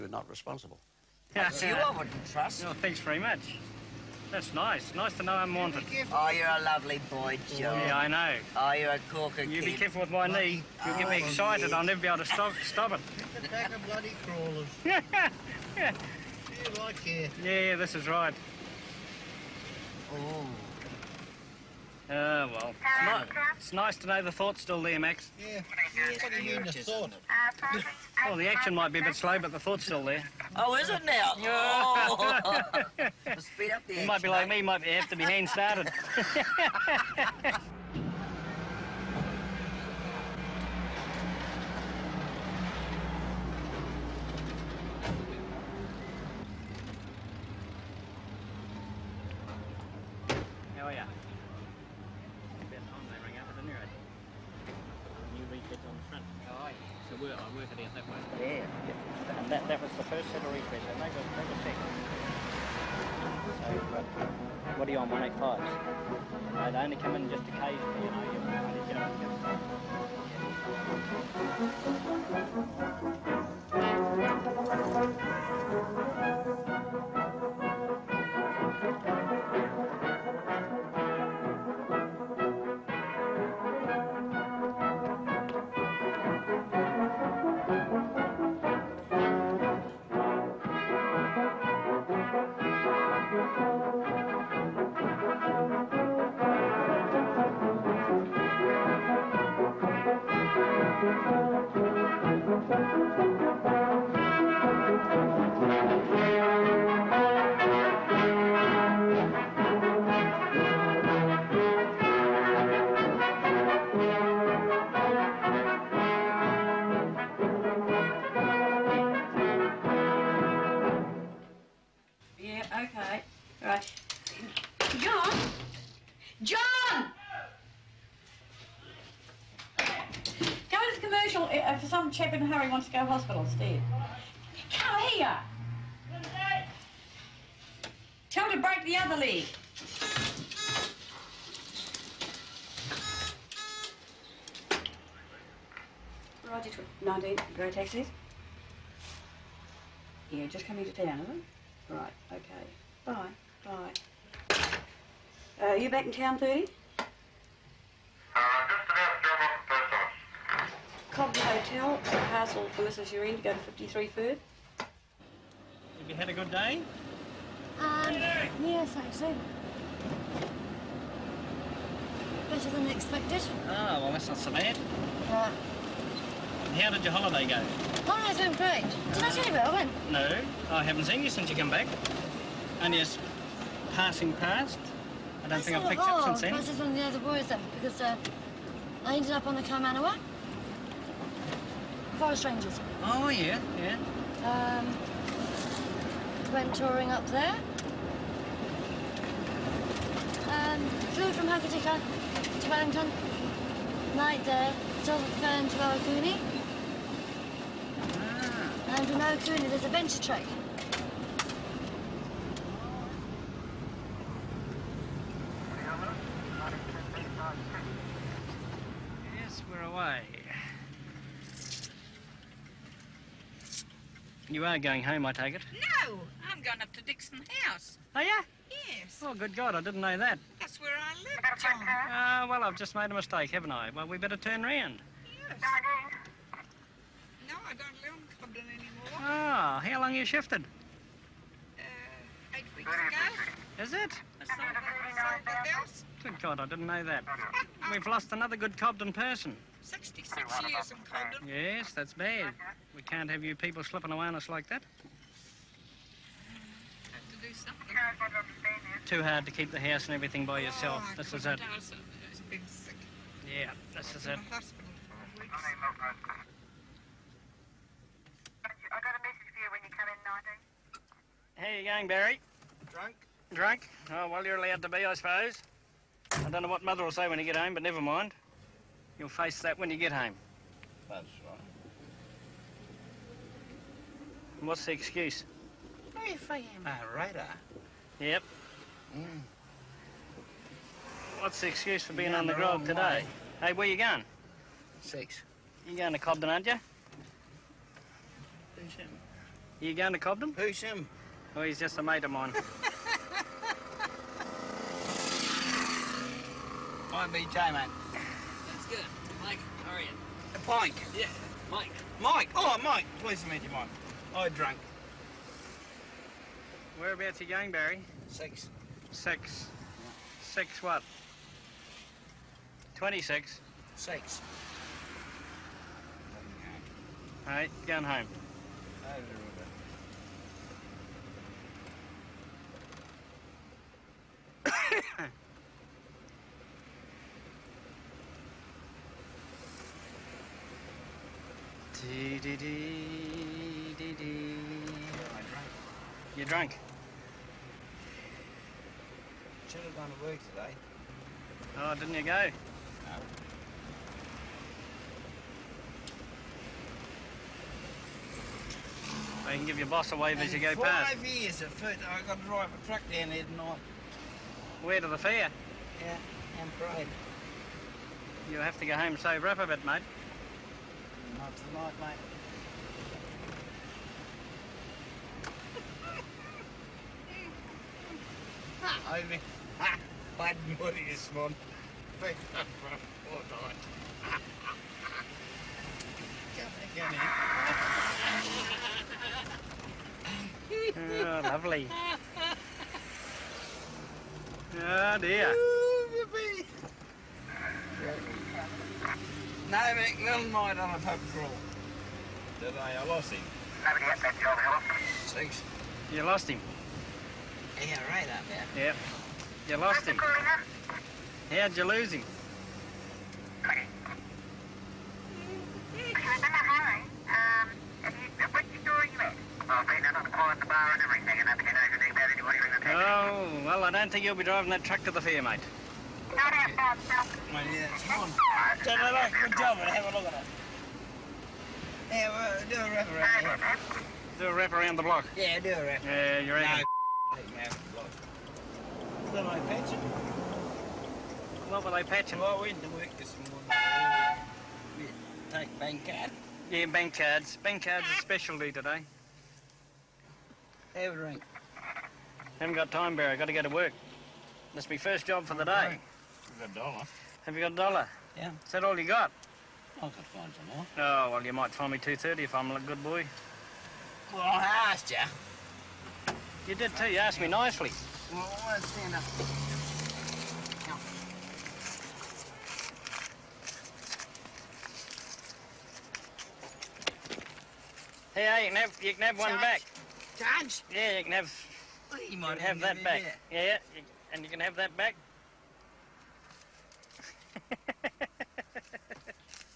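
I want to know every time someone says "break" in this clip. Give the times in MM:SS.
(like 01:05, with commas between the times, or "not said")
02:18.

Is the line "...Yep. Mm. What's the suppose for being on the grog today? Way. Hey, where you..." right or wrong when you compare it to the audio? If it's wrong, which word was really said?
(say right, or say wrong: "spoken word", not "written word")
wrong: "excuse", not "suppose".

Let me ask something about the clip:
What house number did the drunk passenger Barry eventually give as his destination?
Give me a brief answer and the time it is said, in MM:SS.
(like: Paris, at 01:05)
26, at 05:22.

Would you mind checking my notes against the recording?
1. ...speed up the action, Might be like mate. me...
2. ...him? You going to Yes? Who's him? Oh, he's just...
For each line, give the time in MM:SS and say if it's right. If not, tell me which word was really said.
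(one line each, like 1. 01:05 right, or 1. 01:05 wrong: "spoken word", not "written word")
1. 00:33 right
2. 04:58 wrong: "Cobden", not "Yes".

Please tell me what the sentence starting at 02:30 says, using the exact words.
Yeah, just coming to town, is it?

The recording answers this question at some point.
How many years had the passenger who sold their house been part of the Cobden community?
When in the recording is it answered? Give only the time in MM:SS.
04:09.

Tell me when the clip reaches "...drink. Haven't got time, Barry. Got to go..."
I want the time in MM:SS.
07:31.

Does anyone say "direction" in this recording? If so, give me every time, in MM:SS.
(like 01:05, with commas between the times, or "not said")
not said.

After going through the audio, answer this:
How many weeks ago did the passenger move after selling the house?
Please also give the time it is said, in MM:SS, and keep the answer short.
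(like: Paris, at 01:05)
8, at 04:02.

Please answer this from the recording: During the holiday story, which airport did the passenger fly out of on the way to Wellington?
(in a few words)
Hokitika.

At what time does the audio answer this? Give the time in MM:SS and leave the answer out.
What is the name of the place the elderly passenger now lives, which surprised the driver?
03:47.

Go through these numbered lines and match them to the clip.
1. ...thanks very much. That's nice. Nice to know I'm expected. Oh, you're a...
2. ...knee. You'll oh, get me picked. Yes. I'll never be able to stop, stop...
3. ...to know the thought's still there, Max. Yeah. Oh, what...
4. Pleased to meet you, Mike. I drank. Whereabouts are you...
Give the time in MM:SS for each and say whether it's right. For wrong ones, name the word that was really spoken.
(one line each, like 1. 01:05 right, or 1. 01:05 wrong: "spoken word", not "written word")
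1. 00:02 wrong: "wanted", not "expected"
2. 00:10 wrong: "excited", not "picked"
3. 00:23 right
4. 05:13 right.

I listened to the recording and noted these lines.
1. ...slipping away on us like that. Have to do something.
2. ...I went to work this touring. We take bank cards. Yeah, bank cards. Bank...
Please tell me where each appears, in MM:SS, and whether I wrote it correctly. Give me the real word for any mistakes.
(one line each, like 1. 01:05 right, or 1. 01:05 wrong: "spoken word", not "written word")
1. 04:13 right
2. 07:22 wrong: "morning", not "touring".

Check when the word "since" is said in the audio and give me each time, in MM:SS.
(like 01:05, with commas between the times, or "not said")
03:01, 03:06.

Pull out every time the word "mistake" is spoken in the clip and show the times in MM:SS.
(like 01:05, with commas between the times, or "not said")
03:53.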